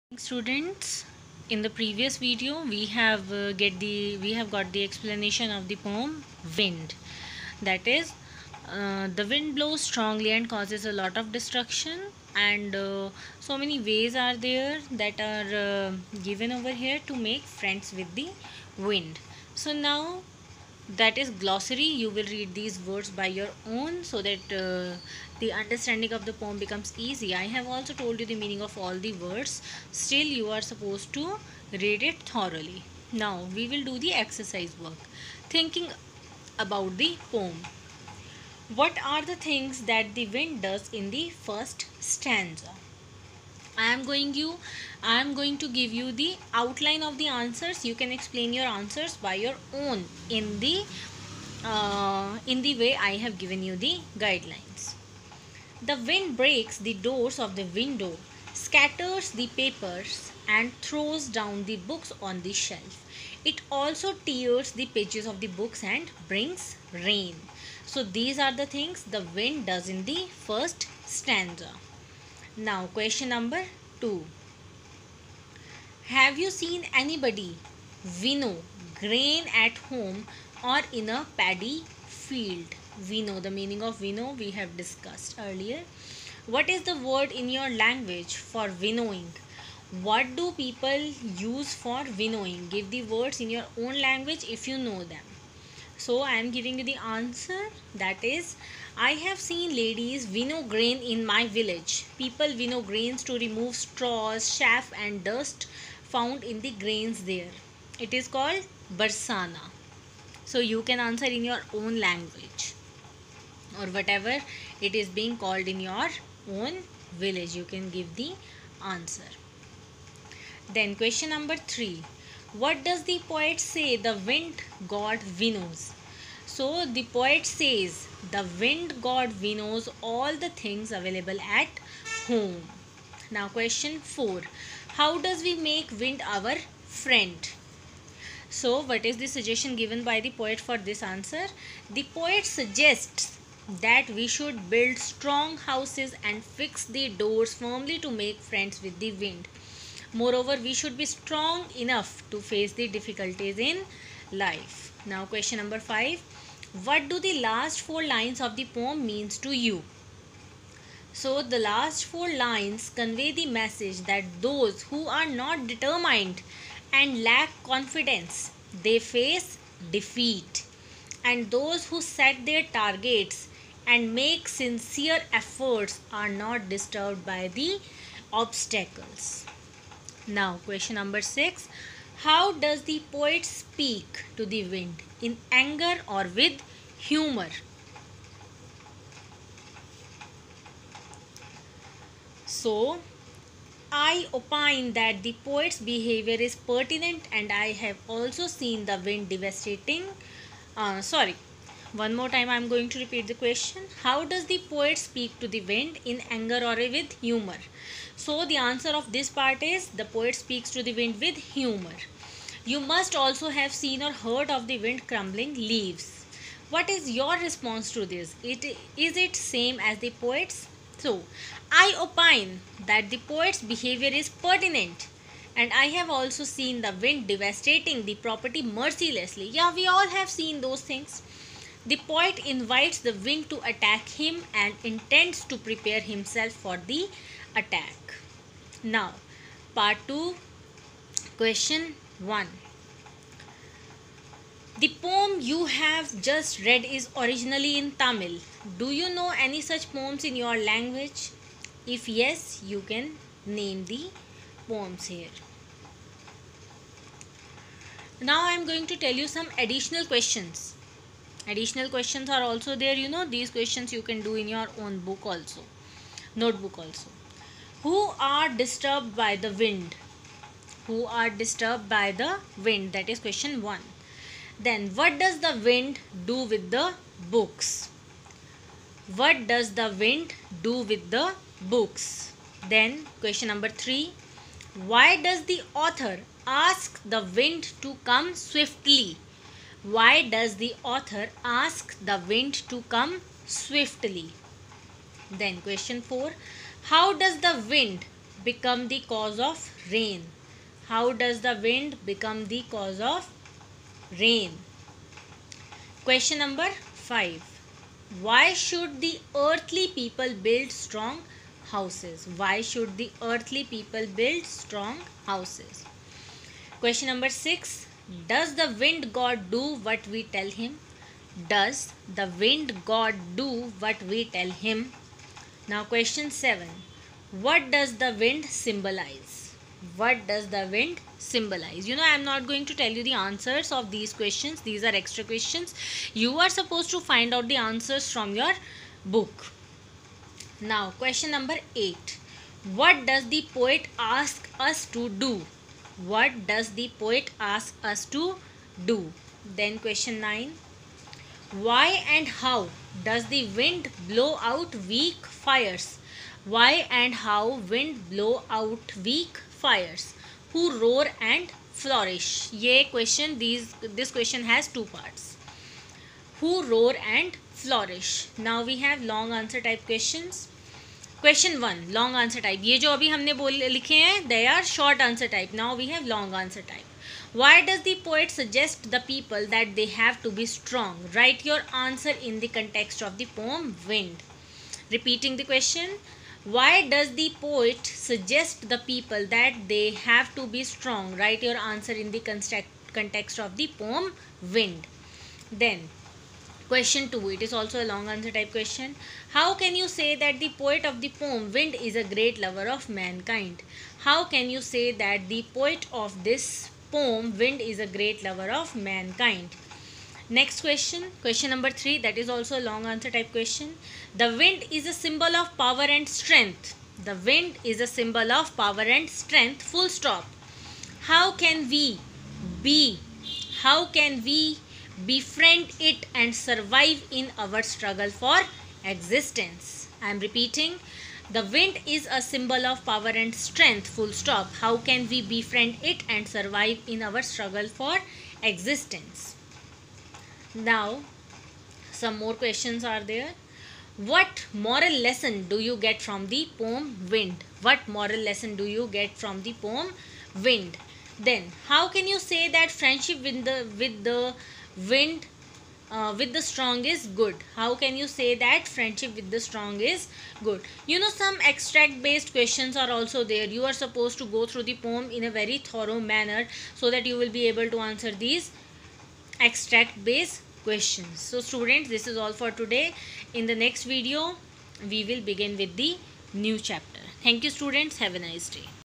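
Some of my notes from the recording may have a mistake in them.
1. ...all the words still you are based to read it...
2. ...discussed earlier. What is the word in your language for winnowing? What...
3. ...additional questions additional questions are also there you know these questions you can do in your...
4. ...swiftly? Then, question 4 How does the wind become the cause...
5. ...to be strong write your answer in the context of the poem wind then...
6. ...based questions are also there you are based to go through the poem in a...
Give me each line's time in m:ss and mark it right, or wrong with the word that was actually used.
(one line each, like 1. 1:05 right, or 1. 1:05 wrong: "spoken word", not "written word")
1. 0:28 wrong: "supposed", not "based"
2. 1:24 right
3. 4:19 right
4. 4:53 right
5. 6:30 right
6. 7:42 wrong: "supposed", not "based".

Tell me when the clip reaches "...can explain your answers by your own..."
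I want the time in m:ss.
0:47.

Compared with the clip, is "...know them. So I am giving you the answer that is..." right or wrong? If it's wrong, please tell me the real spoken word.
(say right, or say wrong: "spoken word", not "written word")
right.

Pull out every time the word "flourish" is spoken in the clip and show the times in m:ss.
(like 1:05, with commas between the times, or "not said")
6:01, 6:07.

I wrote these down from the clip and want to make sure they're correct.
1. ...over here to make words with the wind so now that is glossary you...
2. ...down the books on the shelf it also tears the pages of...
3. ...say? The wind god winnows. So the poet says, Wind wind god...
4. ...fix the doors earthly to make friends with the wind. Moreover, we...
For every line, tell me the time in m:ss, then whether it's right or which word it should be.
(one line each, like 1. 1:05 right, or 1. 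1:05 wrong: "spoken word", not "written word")
1. 0:16 wrong: "friends", not "words"
2. 1:01 right
3. 2:03 wrong: "The", not "Wind"
4. 2:26 wrong: "firmly", not "earthly".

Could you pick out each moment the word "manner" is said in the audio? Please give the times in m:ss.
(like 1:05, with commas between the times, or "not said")
7:45.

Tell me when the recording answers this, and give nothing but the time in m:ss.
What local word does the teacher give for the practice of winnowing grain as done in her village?
1:49.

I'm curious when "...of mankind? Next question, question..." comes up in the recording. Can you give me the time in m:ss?
6:48.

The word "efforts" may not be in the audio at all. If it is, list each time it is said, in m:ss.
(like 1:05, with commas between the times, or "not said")
2:55.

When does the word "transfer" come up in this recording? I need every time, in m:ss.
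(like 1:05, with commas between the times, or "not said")
not said.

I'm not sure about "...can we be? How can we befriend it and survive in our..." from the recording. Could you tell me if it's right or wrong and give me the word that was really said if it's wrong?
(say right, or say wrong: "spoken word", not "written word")
right.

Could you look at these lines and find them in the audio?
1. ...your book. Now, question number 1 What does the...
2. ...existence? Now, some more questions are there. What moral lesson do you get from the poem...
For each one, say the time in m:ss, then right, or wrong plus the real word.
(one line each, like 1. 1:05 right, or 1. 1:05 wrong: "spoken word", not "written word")
1. 5:38 wrong: "8", not "1"
2. 7:18 right.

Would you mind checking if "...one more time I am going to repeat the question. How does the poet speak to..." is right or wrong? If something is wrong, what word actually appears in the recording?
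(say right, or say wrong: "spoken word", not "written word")
right.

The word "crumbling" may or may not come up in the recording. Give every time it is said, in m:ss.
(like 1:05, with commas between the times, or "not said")
3:35.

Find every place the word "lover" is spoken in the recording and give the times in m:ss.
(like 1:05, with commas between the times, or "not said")
6:42, 6:48.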